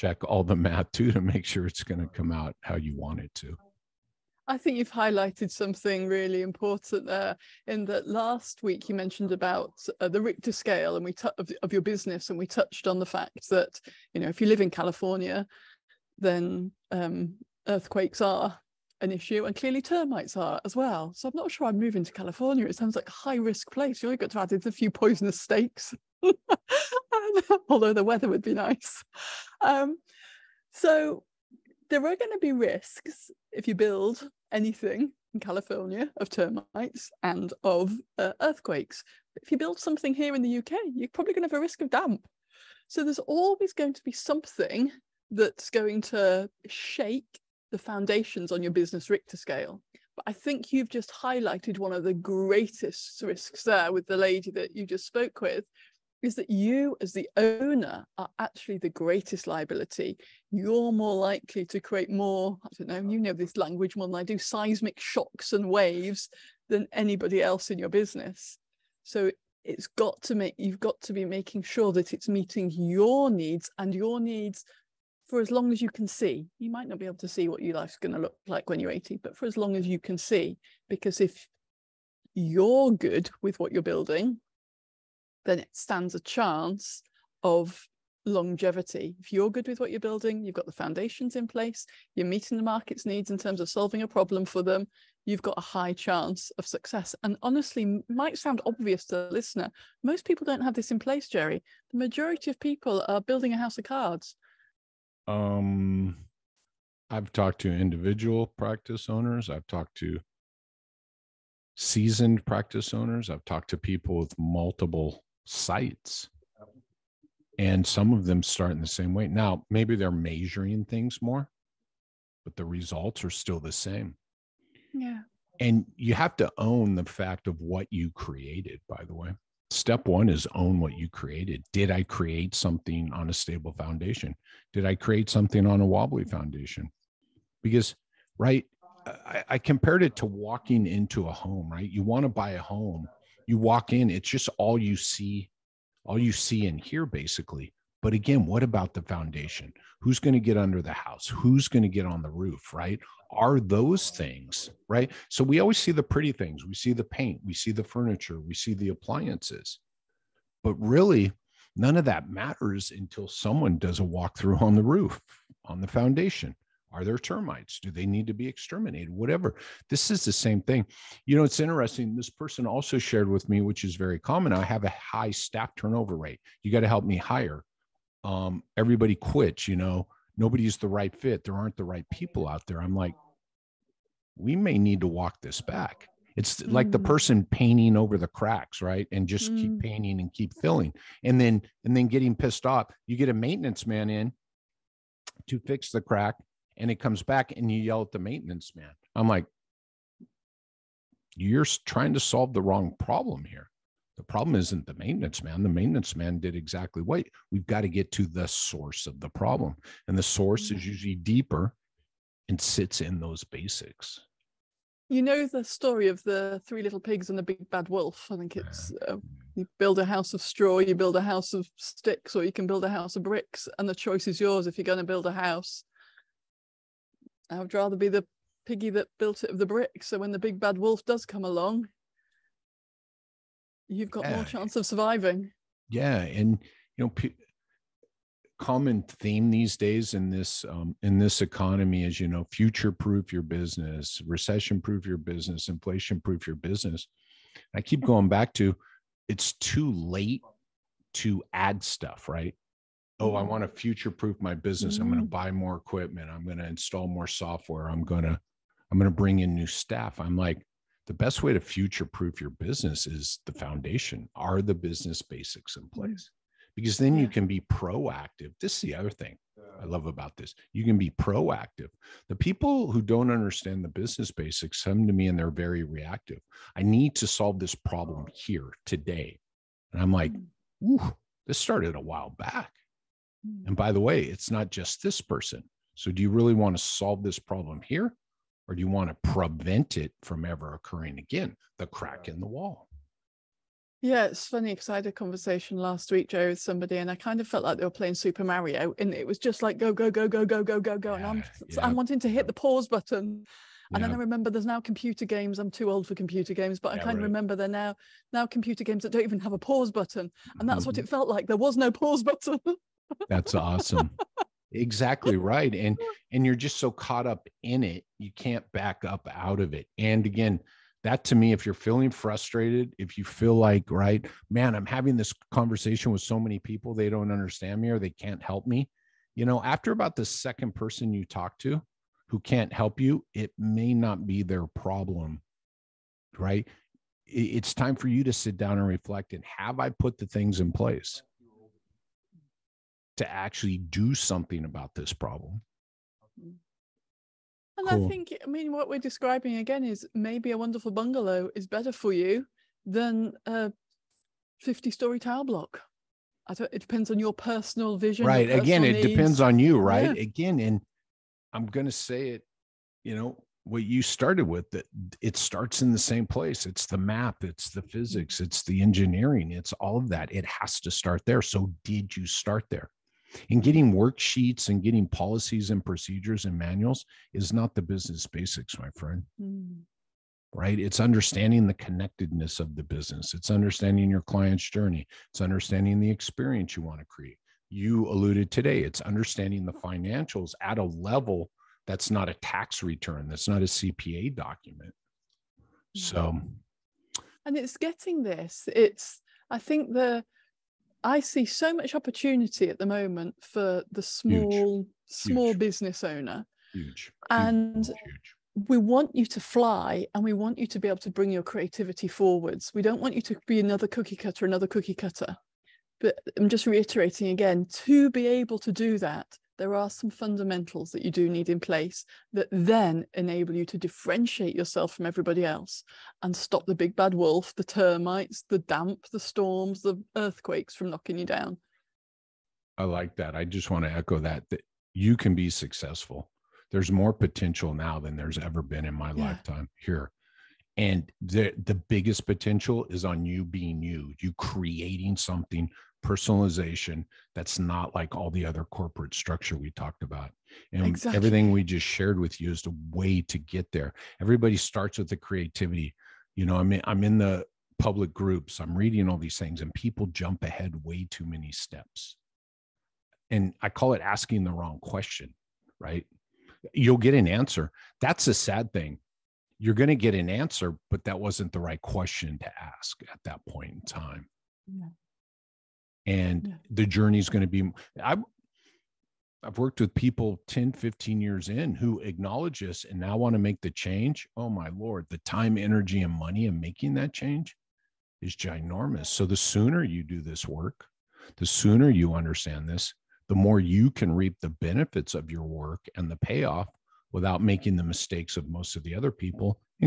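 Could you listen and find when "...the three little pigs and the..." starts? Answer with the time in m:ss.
3:36.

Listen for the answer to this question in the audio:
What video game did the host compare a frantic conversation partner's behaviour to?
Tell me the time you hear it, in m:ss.
4:58.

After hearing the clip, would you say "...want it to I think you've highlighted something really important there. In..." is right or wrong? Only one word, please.
right.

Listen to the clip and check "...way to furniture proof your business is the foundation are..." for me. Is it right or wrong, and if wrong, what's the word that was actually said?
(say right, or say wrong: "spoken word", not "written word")
wrong: "future", not "furniture".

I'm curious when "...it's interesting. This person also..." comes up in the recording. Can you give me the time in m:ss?
2:51.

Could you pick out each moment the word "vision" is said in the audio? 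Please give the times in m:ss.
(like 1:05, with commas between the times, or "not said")
5:57.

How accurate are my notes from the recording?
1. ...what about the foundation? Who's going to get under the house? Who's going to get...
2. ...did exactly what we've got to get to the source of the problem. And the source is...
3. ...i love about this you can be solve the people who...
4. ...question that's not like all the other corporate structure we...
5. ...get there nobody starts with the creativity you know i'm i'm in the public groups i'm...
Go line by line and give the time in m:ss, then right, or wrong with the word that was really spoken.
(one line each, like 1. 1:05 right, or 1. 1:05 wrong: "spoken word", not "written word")
1. 2:28 right
2. 3:26 right
3. 4:29 wrong: "proactive", not "solve"
4. 7:26 wrong: "personalization", not "question"
5. 7:33 wrong: "everybody", not "nobody".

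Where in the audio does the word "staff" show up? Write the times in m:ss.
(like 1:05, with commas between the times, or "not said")
2:55, 4:19.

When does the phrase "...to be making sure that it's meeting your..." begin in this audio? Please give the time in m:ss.
1:11.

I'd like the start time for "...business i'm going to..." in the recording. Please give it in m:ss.
4:14.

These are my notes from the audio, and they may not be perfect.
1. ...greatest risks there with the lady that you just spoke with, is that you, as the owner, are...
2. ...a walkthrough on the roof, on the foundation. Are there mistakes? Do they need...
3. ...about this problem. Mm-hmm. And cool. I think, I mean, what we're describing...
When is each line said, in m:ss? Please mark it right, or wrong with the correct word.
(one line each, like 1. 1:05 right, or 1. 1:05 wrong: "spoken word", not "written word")
1. 0:52 right
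2. 2:43 wrong: "termites", not "mistakes"
3. 5:44 right.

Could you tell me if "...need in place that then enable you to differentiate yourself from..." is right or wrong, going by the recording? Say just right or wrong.
right.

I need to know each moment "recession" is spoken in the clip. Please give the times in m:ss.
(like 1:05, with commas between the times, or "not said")
4:04.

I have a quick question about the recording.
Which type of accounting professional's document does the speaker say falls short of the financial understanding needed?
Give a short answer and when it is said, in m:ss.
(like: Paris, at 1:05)
CPA, at 6:33.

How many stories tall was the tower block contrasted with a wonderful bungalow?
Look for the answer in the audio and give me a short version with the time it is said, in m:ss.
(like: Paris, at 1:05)
50, at 5:54.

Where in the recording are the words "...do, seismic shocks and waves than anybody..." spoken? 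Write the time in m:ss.
1:04.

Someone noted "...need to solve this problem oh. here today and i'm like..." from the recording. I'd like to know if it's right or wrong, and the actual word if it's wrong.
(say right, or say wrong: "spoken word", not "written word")
right.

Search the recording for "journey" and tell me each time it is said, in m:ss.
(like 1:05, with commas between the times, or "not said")
6:24, 7:56.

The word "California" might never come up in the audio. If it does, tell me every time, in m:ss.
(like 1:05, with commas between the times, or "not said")
0:14, 0:22, 0:35.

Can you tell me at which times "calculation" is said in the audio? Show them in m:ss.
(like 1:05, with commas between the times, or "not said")
not said.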